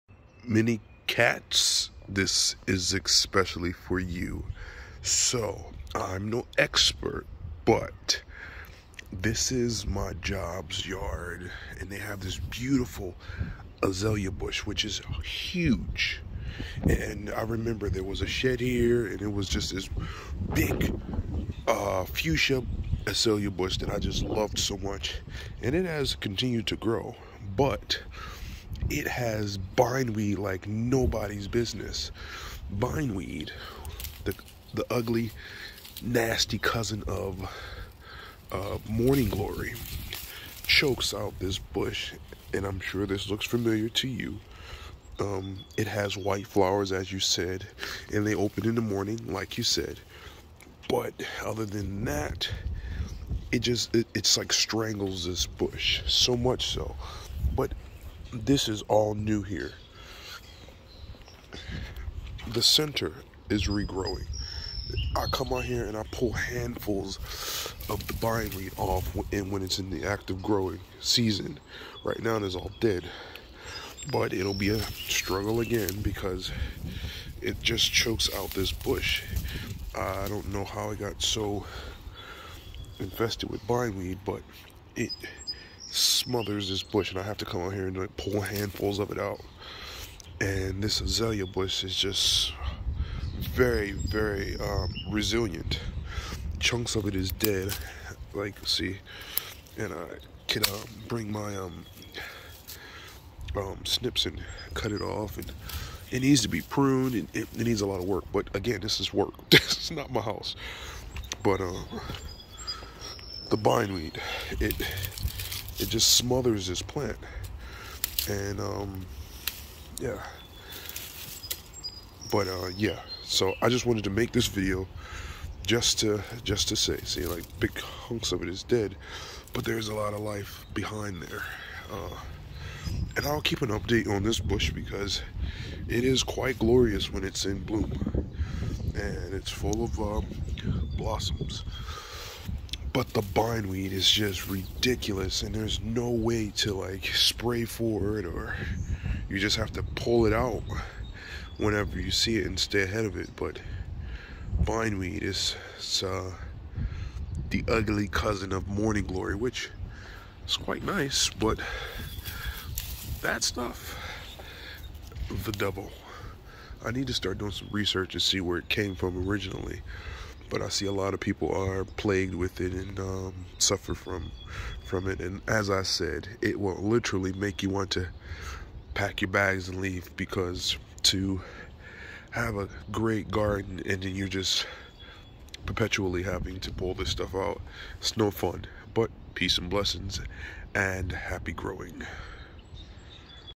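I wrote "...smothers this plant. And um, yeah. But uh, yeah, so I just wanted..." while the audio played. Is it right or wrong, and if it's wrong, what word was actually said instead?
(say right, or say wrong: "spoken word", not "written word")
right.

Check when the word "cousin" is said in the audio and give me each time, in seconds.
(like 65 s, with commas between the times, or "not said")
36 s, 158 s.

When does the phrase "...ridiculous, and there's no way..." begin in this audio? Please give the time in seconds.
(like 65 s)
144 s.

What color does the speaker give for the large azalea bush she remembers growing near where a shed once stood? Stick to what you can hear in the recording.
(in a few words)
Fuchsia.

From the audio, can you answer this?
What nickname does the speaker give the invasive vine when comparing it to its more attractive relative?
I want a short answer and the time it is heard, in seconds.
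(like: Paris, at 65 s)
The devil, at 165 s.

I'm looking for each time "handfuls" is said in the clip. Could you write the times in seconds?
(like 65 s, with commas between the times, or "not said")
66 s, 88 s.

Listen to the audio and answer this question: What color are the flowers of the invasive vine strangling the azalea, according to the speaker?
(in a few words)
White.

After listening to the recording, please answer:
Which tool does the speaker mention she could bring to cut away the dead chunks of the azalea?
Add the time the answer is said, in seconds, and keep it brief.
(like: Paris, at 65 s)
Snips, at 103 s.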